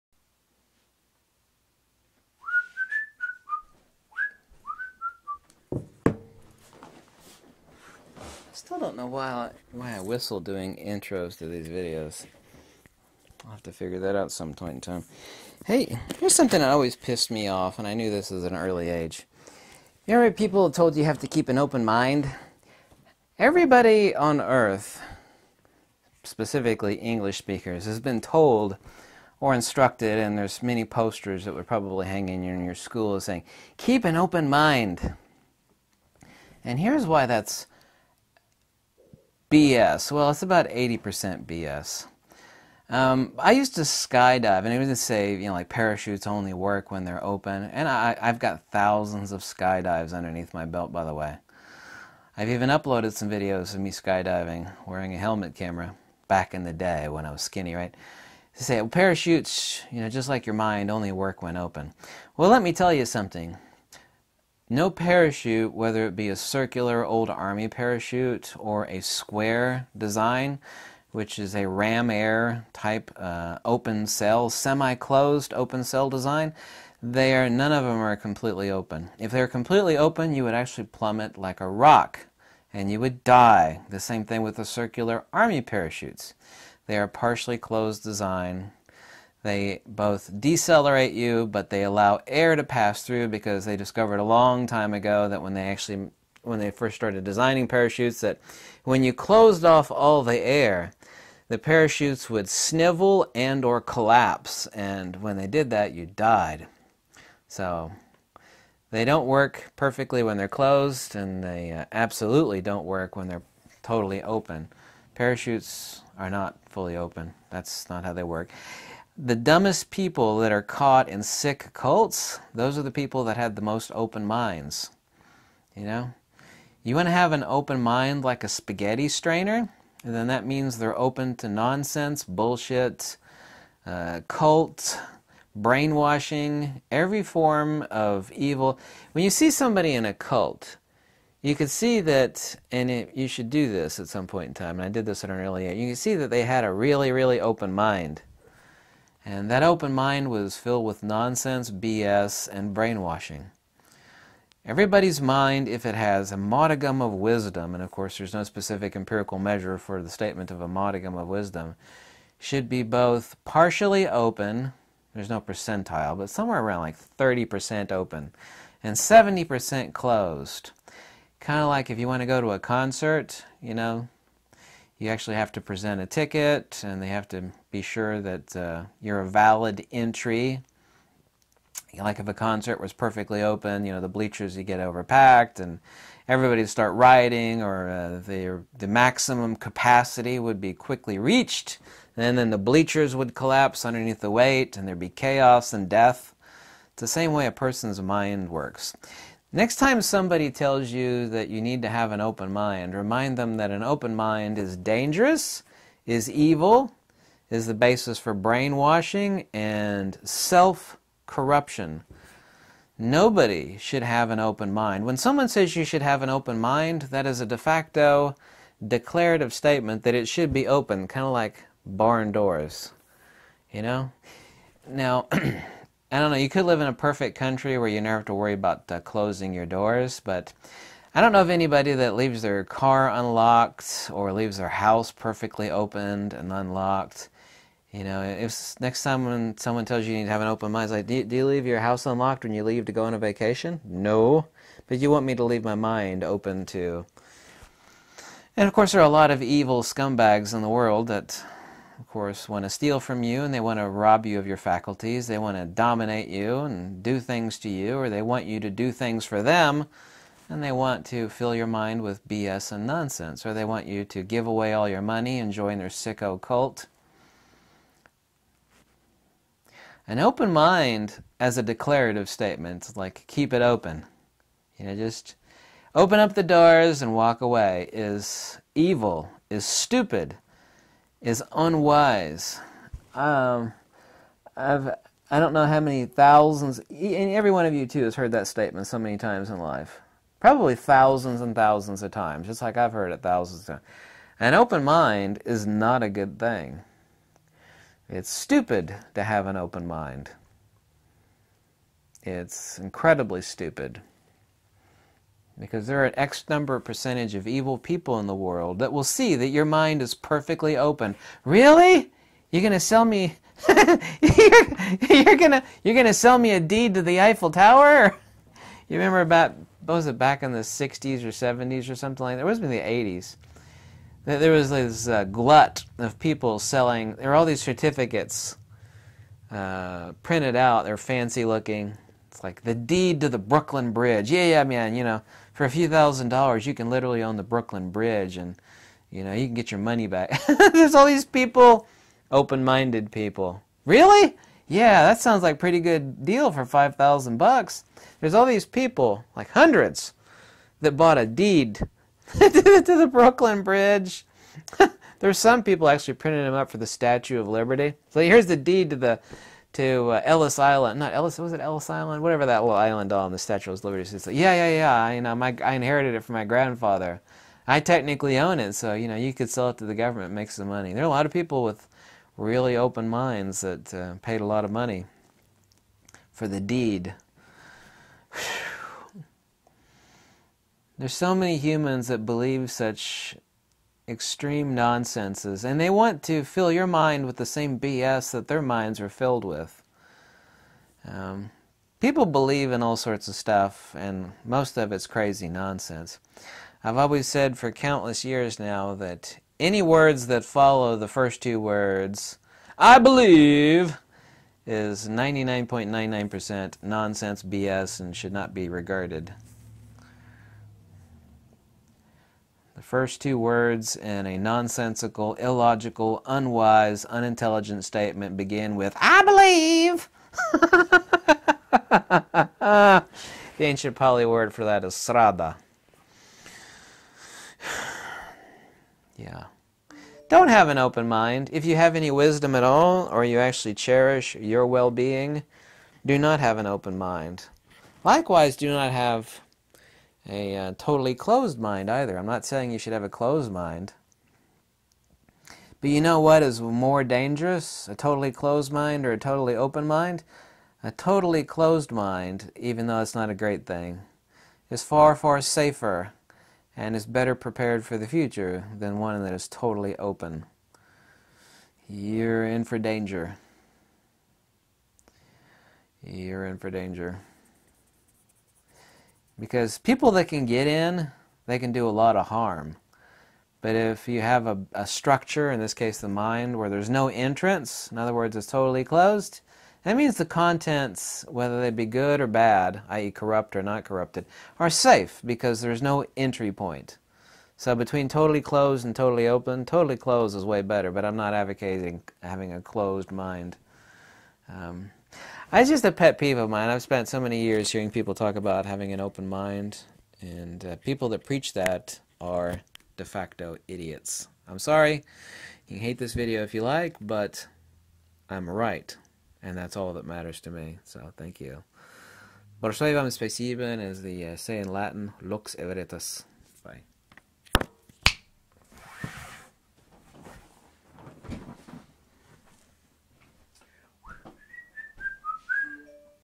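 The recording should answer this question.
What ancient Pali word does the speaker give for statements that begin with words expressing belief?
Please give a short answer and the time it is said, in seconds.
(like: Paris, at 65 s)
srada, at 424 s.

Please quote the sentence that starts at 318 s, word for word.
You remember about what was it back in the 60s or 70s or something like that?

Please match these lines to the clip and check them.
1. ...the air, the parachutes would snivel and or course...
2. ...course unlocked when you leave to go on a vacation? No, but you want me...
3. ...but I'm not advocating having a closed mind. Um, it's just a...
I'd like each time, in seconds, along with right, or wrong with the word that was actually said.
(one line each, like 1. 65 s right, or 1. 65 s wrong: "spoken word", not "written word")
1. 100 s wrong: "collapse", not "course"
2. 241 s wrong: "house", not "course"
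3. 490 s right.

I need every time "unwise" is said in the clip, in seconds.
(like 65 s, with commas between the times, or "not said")
281 s, 416 s.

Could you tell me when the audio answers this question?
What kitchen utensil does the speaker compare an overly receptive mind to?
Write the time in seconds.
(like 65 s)
128 s.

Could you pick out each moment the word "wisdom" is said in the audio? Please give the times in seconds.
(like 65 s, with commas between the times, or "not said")
157 s, 161 s, 432 s.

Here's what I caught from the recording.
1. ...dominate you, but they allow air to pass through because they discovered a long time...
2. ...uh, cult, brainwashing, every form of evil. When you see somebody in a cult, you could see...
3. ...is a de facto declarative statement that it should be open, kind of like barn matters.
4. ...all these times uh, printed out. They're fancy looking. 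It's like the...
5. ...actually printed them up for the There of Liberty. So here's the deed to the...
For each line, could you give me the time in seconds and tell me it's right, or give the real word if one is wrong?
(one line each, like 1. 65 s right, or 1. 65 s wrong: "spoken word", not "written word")
1. 90 s wrong: "decelerate", not "dominate"
2. 133 s right
3. 217 s wrong: "doors", not "matters"
4. 327 s wrong: "certificates", not "times"
5. 355 s wrong: "Statue", not "There".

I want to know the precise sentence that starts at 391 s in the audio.
Um, people believe in all sorts of stuff, and most of it's crazy nonsense.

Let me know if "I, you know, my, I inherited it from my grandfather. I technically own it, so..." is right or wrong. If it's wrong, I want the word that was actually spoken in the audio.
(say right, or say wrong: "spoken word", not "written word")
right.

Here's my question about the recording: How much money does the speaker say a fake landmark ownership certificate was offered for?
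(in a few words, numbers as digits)
$5,000.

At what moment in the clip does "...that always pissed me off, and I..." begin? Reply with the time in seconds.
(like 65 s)
16 s.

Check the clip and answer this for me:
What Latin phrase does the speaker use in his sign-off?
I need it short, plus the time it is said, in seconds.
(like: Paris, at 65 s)
lux et veritas, at 515 s.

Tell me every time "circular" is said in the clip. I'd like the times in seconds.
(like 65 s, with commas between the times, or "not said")
66 s, 84 s.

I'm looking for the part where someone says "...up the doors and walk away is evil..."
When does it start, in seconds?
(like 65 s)
276 s.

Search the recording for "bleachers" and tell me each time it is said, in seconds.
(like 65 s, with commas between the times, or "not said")
184 s, 192 s.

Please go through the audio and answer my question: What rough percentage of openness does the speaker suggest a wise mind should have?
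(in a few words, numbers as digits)
30%.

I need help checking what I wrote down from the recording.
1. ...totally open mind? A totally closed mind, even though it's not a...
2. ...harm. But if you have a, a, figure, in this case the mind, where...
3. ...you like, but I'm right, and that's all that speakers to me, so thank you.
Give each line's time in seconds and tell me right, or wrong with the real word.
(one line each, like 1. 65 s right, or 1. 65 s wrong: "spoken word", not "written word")
1. 449 s right
2. 472 s wrong: "structure", not "figure"
3. 506 s wrong: "matters", not "speakers".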